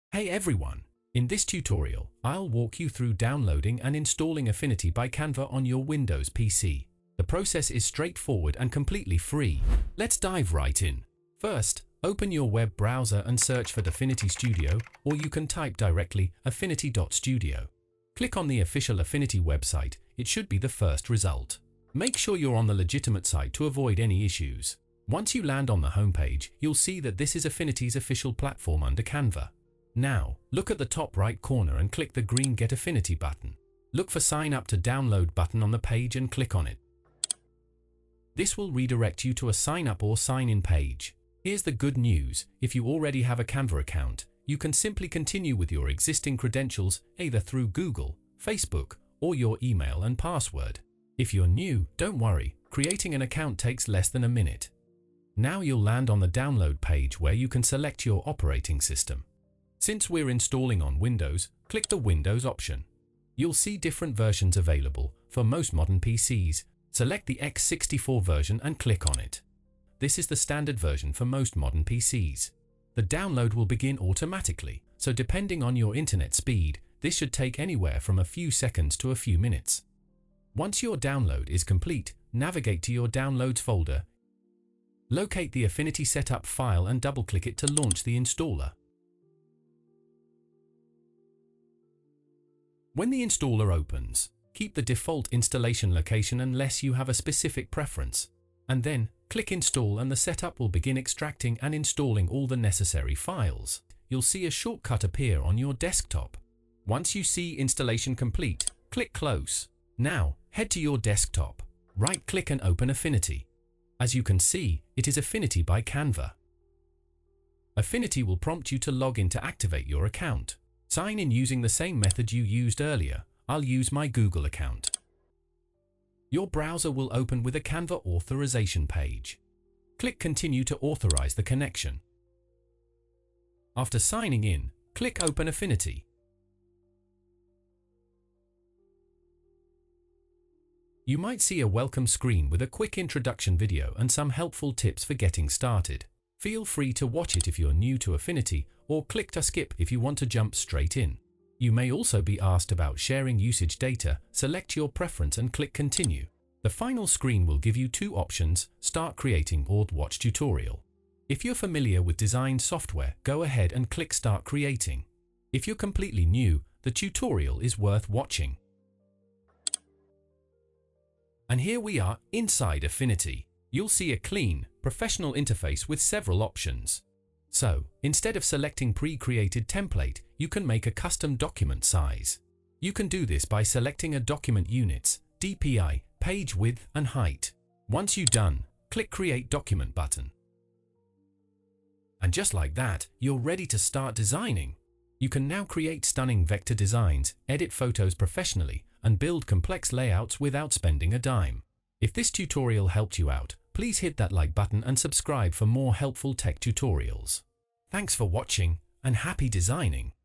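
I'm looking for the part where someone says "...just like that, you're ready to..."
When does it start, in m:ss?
3:12.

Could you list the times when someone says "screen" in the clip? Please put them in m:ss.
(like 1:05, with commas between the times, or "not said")
2:22, 2:37.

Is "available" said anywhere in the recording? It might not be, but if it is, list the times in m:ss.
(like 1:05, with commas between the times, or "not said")
1:04.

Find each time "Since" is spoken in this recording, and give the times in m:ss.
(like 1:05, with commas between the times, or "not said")
0:59.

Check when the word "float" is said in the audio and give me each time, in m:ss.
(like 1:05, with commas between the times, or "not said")
not said.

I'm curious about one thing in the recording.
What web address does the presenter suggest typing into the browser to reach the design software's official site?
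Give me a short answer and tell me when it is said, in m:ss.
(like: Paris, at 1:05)
affinity.studio, at 0:16.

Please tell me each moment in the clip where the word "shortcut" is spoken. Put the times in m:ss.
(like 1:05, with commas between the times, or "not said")
1:44.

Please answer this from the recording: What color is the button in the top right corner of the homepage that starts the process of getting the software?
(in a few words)
Green.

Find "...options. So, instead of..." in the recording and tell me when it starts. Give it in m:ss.
2:56.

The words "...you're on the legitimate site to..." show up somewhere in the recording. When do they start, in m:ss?
0:22.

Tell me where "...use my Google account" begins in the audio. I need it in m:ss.
2:03.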